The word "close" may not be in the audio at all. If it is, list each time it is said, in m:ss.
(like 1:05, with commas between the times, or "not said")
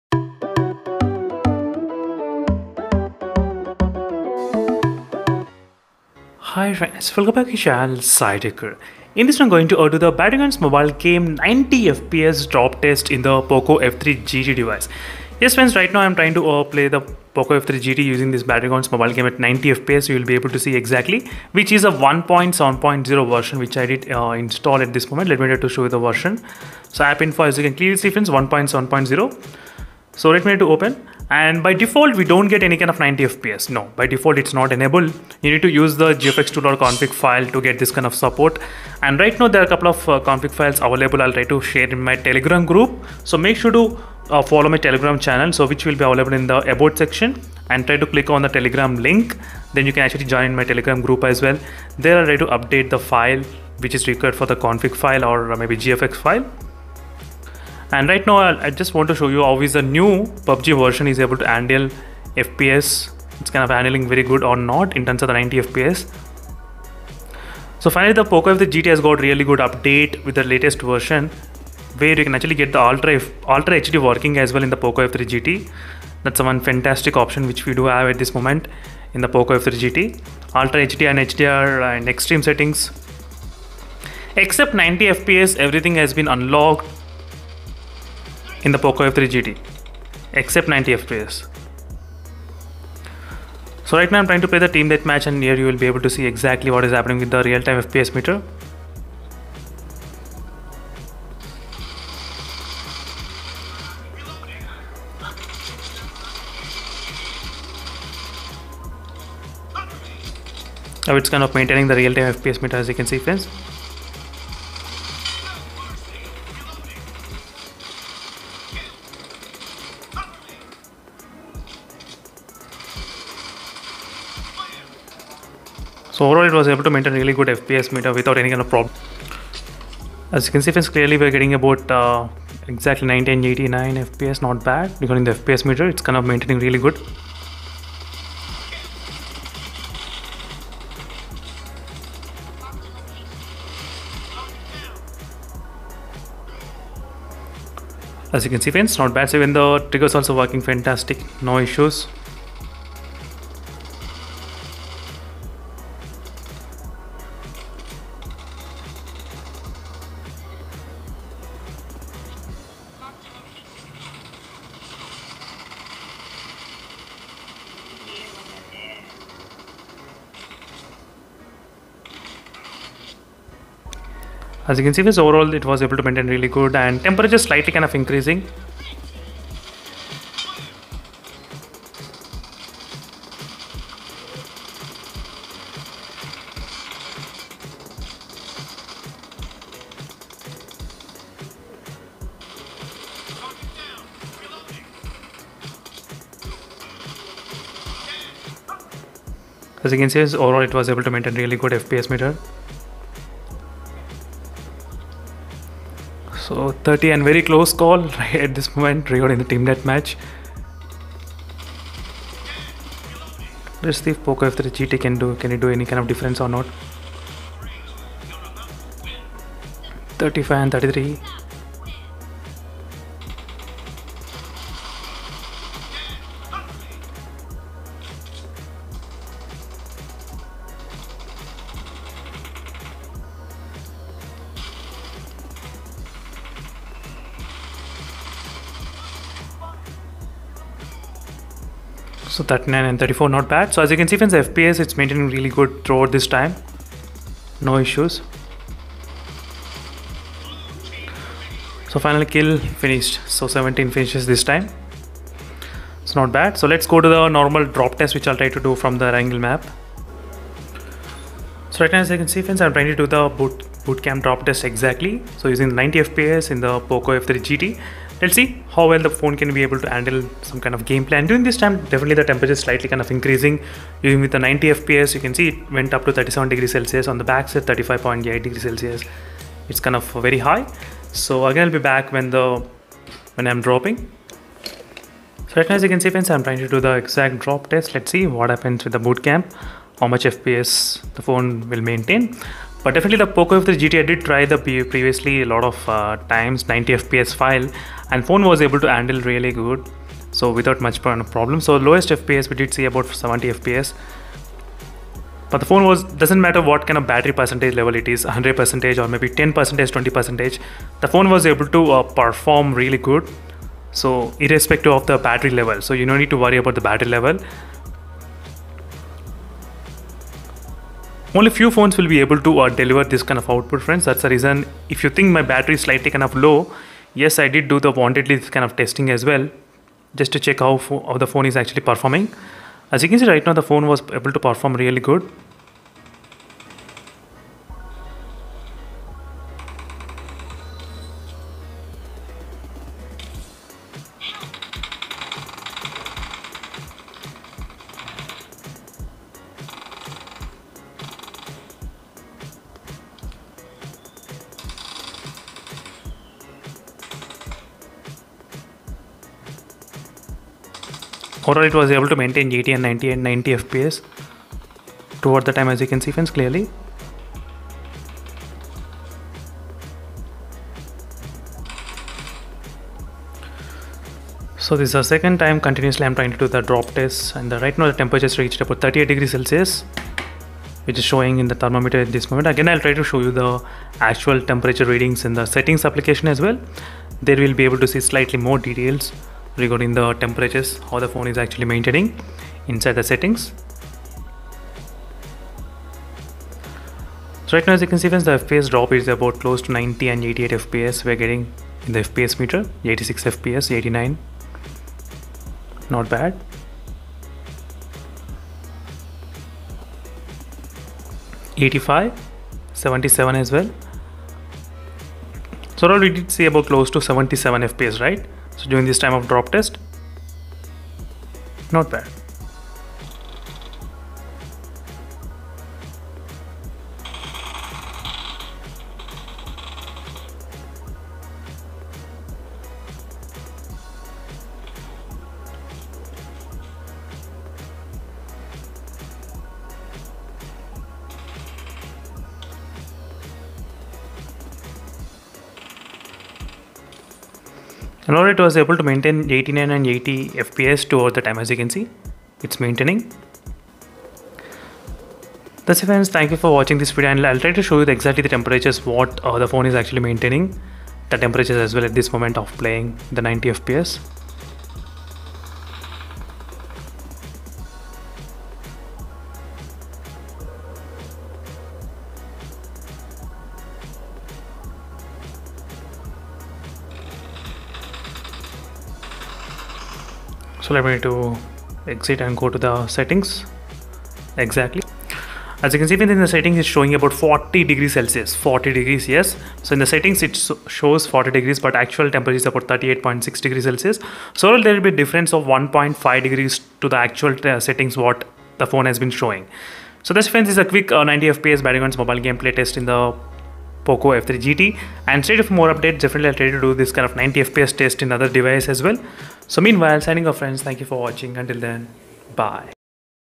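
3:27, 6:39, 6:56.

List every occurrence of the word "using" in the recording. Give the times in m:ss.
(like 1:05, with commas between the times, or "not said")
0:18, 4:25.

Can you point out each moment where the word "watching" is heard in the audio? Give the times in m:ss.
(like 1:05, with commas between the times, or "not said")
7:36, 8:30.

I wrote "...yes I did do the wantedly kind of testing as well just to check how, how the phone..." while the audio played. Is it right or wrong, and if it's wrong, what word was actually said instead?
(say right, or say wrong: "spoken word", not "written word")
right.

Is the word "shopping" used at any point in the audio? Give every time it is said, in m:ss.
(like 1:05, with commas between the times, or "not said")
not said.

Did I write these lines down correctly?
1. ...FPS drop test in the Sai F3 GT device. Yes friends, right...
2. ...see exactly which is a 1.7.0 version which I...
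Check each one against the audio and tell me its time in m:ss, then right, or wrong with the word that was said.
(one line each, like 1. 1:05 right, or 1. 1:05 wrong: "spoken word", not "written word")
1. 0:11 wrong: "POCO", not "Sai"
2. 0:20 right.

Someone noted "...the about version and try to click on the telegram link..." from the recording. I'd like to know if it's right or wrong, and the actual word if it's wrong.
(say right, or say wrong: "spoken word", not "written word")
wrong: "section", not "version".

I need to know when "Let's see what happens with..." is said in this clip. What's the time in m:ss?
4:47.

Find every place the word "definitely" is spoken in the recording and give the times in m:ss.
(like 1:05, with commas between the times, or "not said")
4:31, 4:52, 8:25.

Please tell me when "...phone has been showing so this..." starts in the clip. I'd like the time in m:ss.
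8:18.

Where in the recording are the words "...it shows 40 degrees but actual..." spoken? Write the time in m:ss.
8:10.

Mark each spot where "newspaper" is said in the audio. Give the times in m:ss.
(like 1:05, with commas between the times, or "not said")
not said.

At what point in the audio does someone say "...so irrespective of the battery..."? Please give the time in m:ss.
5:13.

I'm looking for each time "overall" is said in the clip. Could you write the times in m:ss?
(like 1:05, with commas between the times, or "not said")
2:06, 2:55, 3:20, 6:01, 6:55.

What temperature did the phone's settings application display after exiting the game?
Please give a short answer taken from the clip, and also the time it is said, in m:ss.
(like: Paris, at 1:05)
40 degrees, at 8:07.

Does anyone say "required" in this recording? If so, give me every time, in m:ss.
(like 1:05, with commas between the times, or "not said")
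0:54.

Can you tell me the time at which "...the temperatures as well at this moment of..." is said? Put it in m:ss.
7:41.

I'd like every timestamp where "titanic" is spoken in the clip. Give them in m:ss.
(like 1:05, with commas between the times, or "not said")
not said.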